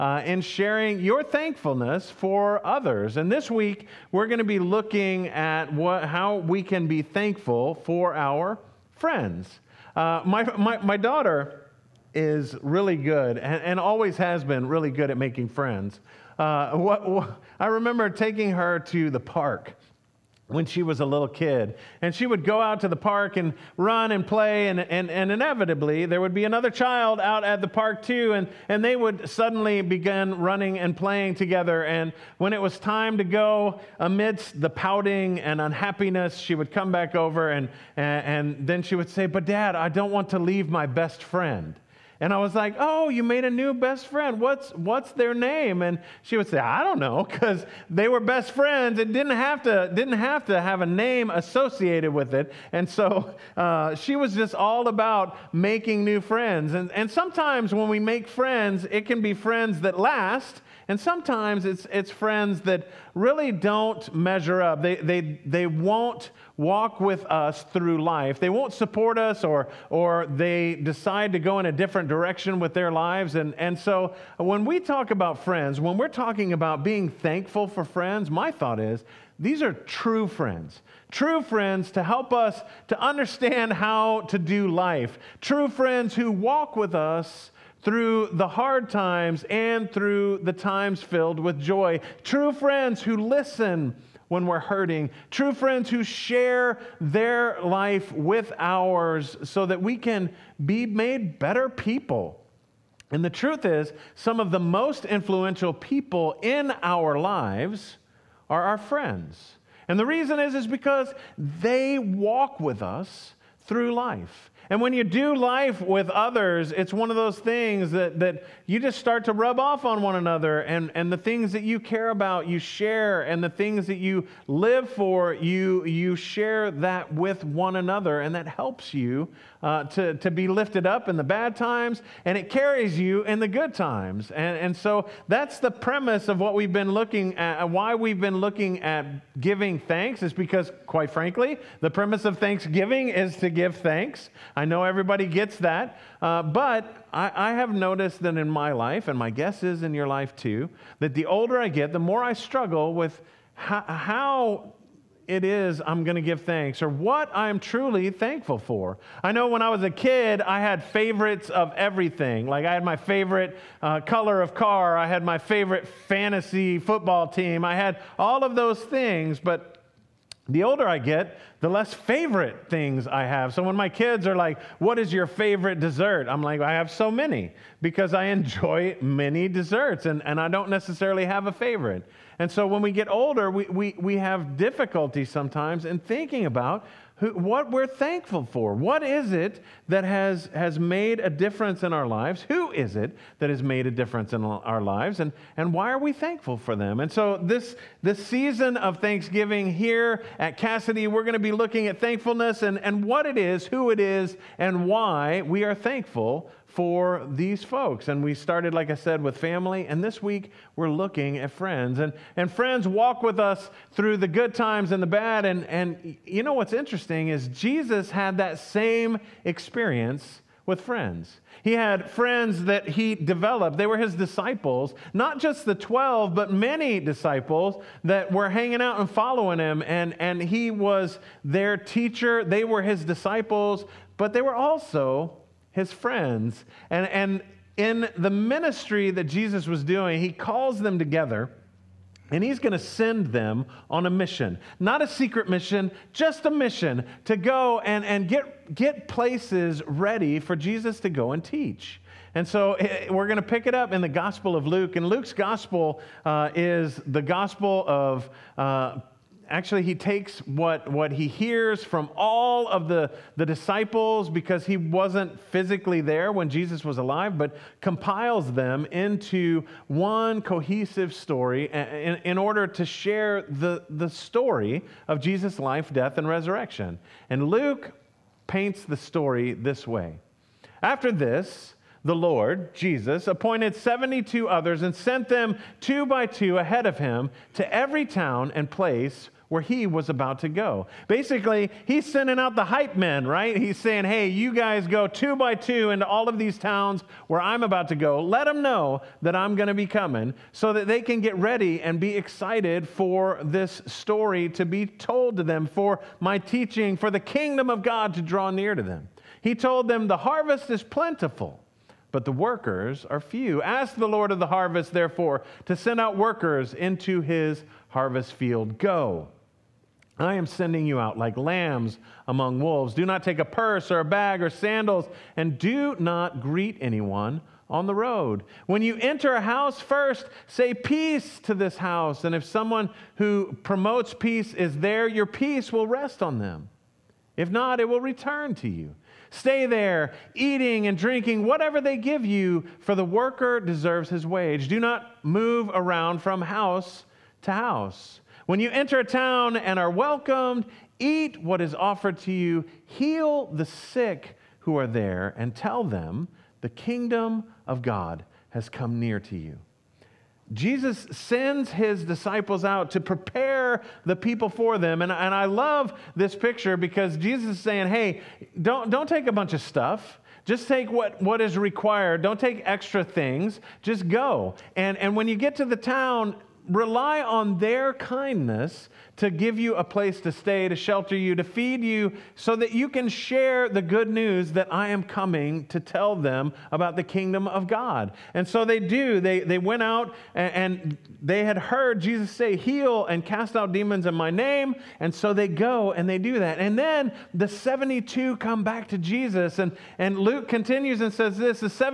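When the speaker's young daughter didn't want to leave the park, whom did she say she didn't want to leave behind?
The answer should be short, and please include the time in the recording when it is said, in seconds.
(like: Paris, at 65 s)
my best friend, at 40 s.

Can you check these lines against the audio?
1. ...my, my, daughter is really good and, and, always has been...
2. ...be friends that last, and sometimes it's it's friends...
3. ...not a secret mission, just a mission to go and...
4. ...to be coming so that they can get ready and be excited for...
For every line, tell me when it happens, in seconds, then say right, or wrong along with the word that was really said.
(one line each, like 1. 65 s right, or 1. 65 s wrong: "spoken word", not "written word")
1. 10 s right
2. 59 s right
3. 244 s right
4. 299 s right.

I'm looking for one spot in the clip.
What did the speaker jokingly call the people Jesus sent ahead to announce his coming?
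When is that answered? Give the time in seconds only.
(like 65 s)
292 s.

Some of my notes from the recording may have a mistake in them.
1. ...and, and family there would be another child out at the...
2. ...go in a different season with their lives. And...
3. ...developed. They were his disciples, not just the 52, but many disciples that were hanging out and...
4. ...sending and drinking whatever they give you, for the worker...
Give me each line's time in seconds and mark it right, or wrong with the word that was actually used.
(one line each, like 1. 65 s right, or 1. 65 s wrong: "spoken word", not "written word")
1. 24 s wrong: "inevitably", not "family"
2. 71 s wrong: "direction", not "season"
3. 223 s wrong: "12", not "52"
4. 340 s wrong: "eating", not "sending".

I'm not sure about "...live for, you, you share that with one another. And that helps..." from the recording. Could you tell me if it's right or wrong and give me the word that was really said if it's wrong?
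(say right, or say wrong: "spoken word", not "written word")
right.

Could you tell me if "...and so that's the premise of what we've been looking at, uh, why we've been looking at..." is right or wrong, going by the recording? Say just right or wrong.
right.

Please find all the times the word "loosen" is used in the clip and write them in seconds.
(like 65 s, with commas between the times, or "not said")
not said.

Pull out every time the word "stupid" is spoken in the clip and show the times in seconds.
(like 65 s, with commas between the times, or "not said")
not said.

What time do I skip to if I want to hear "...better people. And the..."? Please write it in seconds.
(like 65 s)
101 s.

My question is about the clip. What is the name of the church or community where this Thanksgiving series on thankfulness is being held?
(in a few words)
Cassidy.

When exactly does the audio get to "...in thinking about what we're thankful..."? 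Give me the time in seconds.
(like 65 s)
185 s.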